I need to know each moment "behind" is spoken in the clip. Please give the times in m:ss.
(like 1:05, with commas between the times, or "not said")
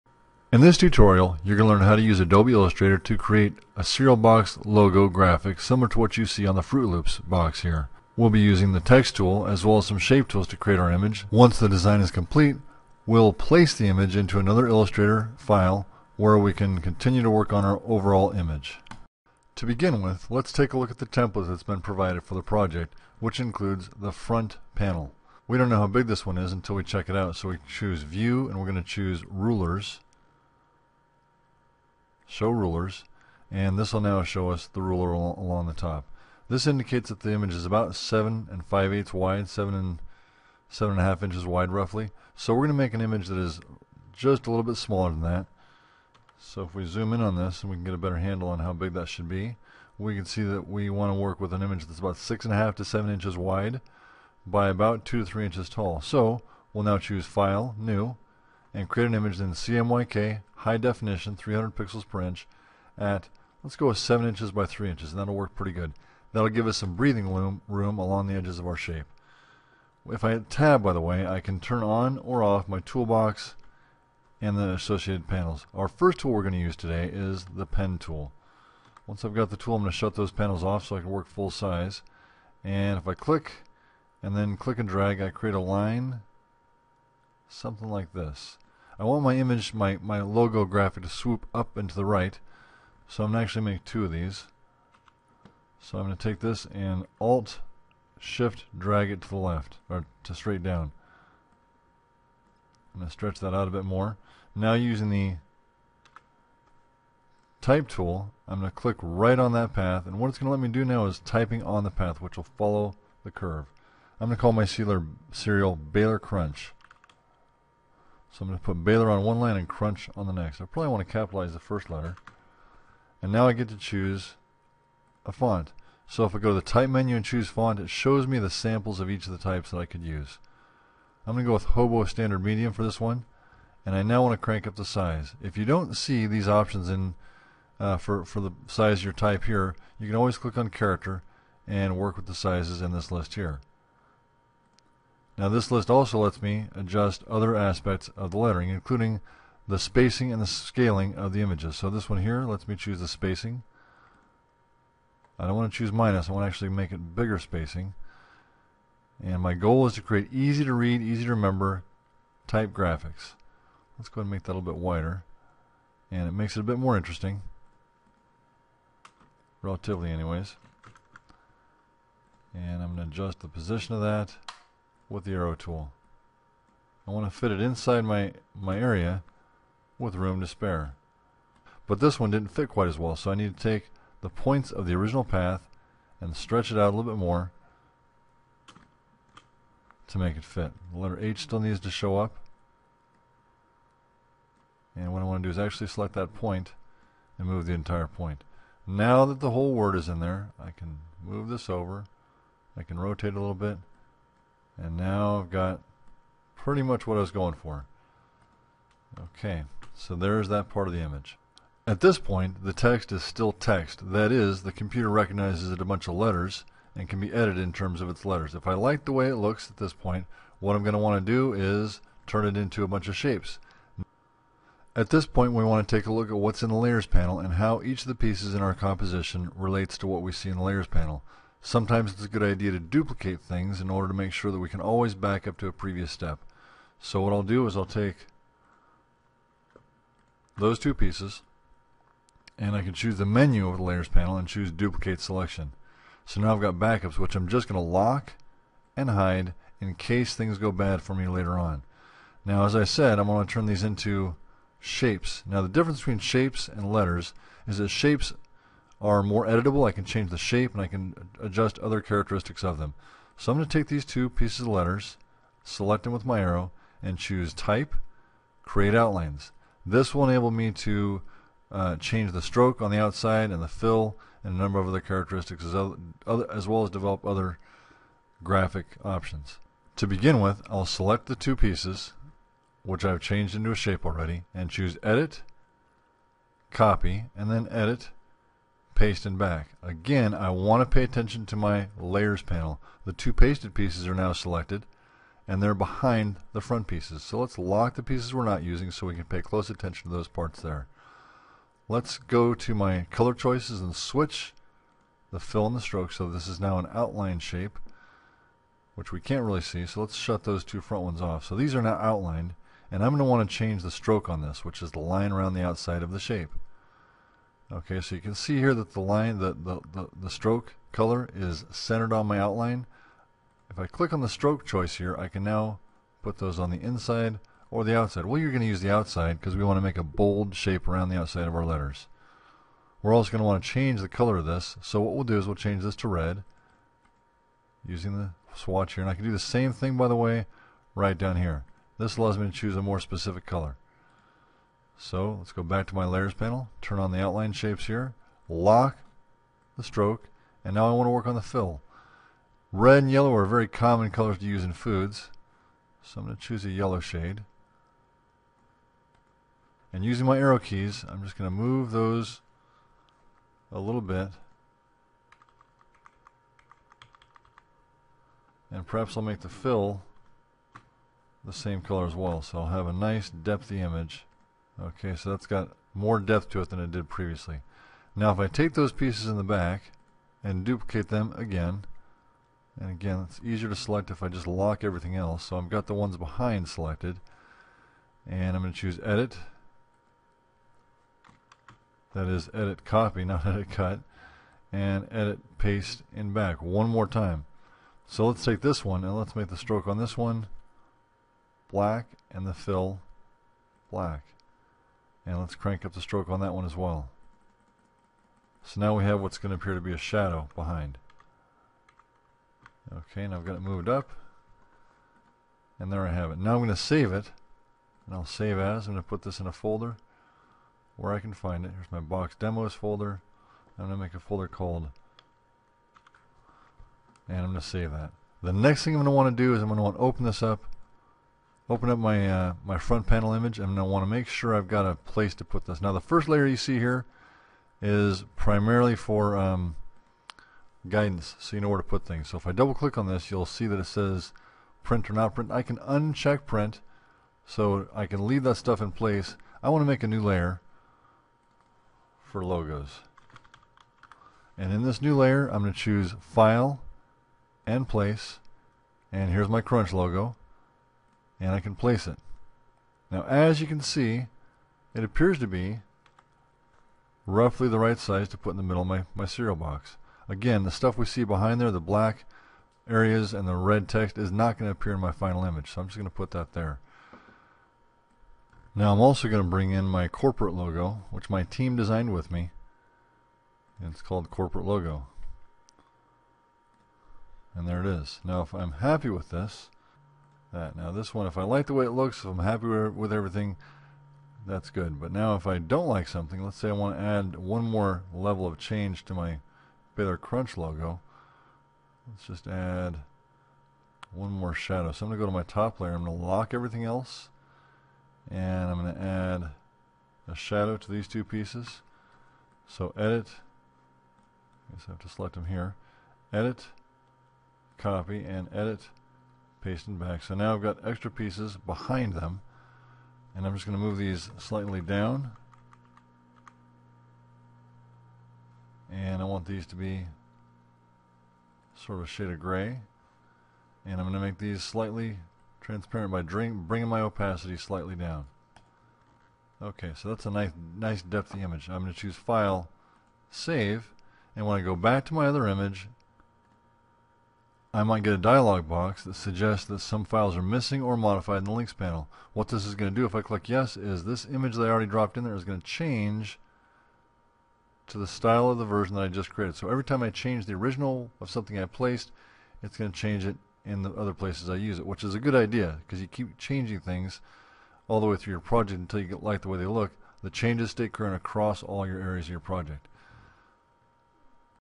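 4:55, 6:26, 6:50, 7:51, 8:41.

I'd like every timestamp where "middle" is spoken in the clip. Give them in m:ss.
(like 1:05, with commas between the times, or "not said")
7:48.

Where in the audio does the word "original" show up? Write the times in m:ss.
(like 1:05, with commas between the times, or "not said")
3:04, 9:20.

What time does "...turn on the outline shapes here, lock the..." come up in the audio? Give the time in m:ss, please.
5:46.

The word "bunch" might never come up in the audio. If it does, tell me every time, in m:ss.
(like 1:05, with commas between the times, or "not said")
3:35, 3:42.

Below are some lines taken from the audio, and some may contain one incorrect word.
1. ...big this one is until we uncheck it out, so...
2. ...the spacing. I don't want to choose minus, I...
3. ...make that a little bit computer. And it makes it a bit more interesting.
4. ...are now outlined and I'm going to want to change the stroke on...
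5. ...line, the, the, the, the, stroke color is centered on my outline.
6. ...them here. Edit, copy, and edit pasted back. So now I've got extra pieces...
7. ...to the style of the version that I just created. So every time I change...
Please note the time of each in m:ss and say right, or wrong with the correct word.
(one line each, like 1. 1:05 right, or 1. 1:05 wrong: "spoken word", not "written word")
1. 0:25 wrong: "check", not "uncheck"
2. 2:32 right
3. 2:44 wrong: "wider", not "computer"
4. 5:11 right
5. 5:18 right
6. 8:35 right
7. 9:17 right.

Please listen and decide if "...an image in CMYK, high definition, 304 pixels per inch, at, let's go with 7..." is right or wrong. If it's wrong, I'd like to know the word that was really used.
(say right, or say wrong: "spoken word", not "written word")
wrong: "300", not "304".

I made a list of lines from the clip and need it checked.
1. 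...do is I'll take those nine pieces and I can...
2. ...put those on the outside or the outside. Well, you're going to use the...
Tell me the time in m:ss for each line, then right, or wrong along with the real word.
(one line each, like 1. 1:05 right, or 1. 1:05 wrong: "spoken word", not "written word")
1. 3:57 wrong: "two", not "nine"
2. 5:26 wrong: "inside", not "outside".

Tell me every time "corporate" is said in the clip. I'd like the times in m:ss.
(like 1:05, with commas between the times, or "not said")
8:00, 8:04.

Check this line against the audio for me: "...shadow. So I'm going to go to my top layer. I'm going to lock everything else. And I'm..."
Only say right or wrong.
right.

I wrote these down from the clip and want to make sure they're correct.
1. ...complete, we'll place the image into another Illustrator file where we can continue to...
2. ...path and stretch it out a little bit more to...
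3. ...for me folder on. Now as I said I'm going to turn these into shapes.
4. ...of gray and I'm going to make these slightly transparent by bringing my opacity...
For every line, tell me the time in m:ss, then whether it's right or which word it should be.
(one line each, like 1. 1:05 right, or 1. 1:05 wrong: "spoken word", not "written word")
1. 0:12 right
2. 3:05 right
3. 4:11 wrong: "later", not "folder"
4. 8:52 right.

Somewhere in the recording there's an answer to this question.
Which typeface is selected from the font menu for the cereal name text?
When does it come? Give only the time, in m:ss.
2:11.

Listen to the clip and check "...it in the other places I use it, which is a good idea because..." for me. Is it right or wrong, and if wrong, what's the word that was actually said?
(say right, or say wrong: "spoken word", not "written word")
right.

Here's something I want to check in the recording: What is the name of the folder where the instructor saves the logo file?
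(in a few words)
box demos.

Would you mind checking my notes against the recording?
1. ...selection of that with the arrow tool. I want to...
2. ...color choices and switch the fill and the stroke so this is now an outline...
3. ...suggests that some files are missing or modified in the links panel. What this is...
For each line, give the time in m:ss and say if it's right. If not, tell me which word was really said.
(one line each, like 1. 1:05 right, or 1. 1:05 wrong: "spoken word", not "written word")
1. 2:53 wrong: "position", not "selection"
2. 5:03 right
3. 9:09 right.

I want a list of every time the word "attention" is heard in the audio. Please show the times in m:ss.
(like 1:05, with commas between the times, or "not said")
4:51, 4:59.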